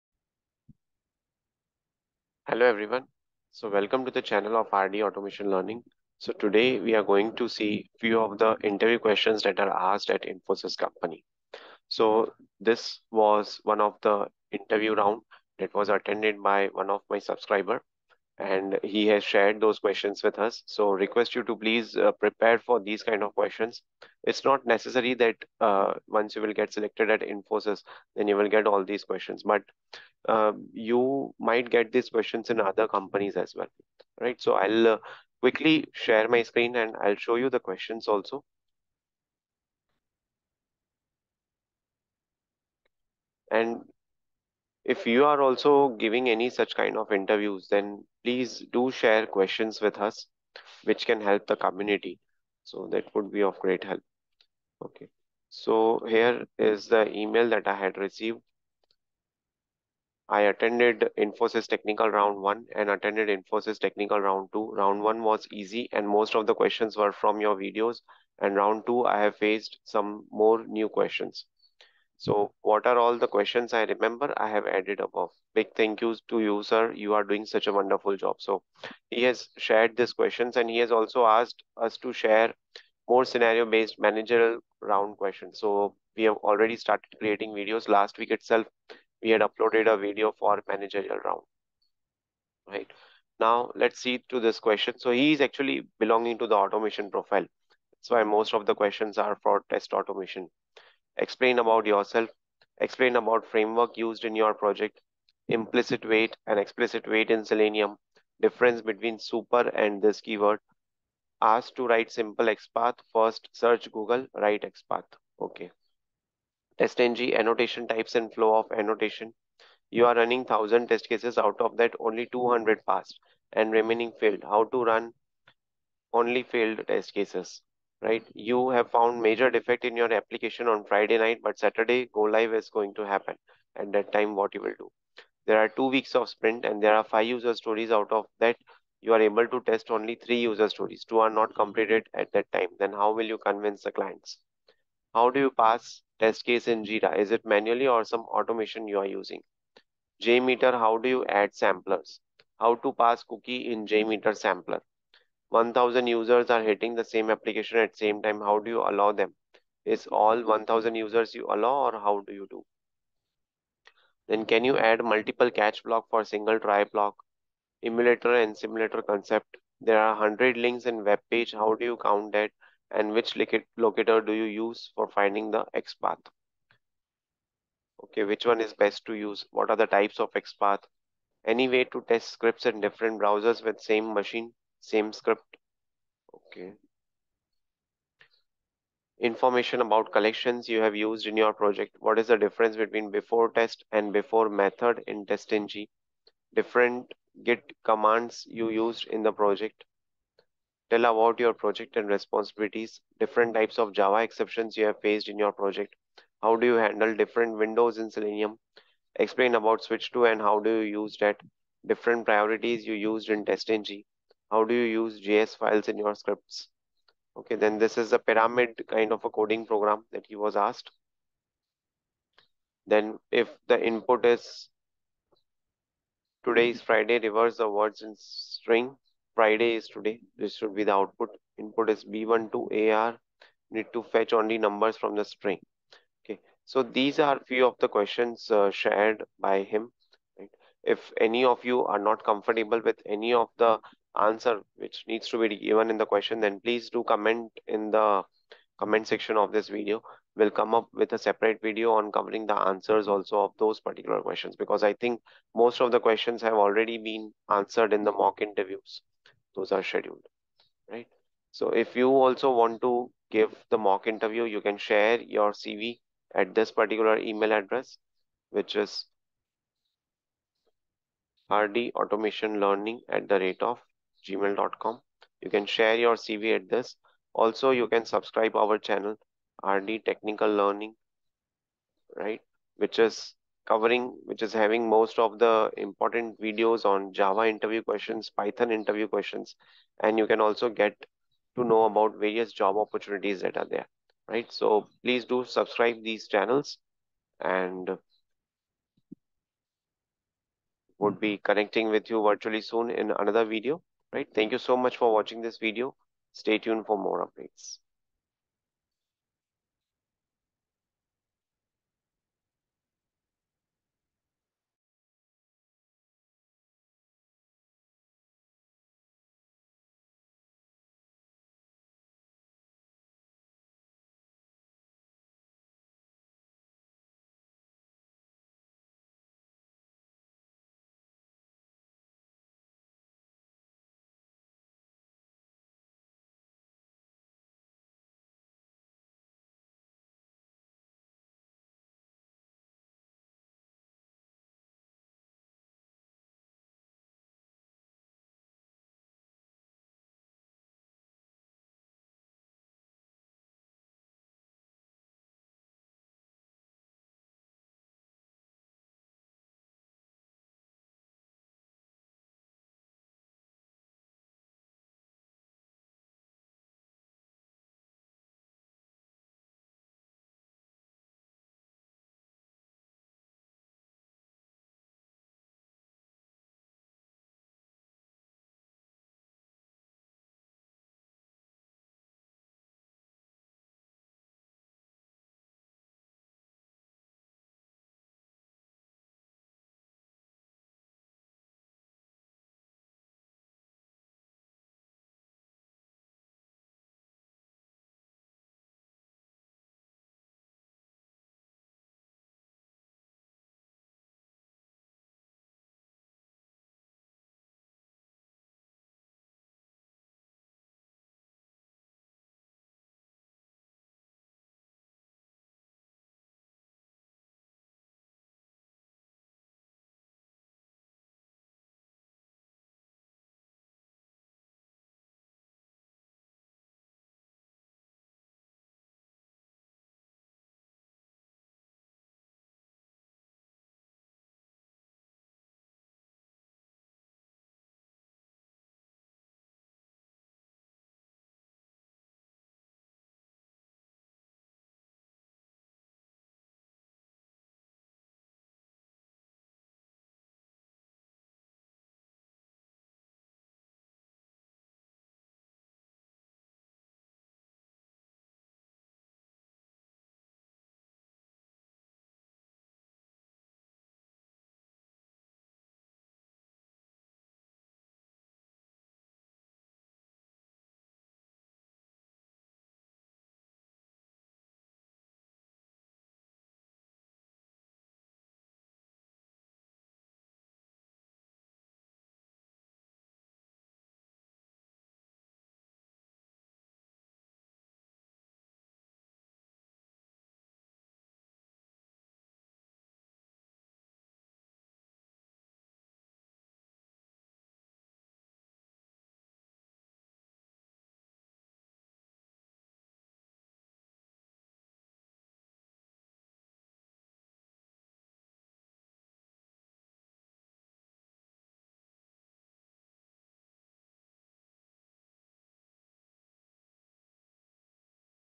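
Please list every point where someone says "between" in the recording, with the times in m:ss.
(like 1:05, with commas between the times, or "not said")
1:48, 3:12.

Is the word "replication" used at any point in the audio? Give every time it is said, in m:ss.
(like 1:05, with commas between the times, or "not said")
not said.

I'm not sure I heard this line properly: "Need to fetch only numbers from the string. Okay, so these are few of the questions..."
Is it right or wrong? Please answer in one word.
right.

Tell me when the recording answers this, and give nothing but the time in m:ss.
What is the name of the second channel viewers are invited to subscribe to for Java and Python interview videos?
4:39.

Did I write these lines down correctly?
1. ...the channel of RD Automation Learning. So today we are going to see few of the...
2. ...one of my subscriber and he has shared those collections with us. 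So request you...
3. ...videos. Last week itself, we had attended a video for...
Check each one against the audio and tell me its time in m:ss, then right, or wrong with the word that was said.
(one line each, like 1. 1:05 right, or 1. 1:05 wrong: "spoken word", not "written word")
1. 0:04 right
2. 0:16 wrong: "questions", not "collections"
3. 1:27 wrong: "uploaded", not "attended".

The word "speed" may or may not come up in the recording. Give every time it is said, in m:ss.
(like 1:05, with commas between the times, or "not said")
not said.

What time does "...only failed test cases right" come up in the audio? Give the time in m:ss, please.
2:06.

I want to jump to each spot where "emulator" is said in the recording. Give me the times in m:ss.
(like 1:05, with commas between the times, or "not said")
2:47.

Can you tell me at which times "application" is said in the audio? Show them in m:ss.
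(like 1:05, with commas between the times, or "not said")
2:10, 2:37.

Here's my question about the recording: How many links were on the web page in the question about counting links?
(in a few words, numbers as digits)
100.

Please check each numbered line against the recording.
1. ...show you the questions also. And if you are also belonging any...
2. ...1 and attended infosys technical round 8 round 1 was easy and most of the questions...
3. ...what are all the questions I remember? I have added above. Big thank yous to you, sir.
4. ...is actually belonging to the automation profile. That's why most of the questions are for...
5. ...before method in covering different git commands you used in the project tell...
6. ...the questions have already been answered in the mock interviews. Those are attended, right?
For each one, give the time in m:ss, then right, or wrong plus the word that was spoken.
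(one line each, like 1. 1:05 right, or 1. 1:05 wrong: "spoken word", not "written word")
1. 0:37 wrong: "giving", not "belonging"
2. 1:02 wrong: "2", not "8"
3. 1:12 right
4. 1:35 right
5. 3:14 wrong: "testng", not "covering"
6. 4:15 wrong: "scheduled", not "attended".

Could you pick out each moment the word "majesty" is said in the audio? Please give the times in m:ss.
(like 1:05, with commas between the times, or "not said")
not said.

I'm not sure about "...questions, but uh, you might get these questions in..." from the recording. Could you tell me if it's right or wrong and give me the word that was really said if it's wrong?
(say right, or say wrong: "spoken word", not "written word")
right.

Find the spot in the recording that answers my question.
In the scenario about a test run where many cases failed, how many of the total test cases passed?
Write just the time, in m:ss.
2:02.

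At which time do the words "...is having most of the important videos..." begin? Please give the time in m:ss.
4:44.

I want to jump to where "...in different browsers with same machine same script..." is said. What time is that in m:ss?
3:02.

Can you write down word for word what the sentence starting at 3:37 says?
Okay, then this is a pyramid kind of a coding program that he was asked.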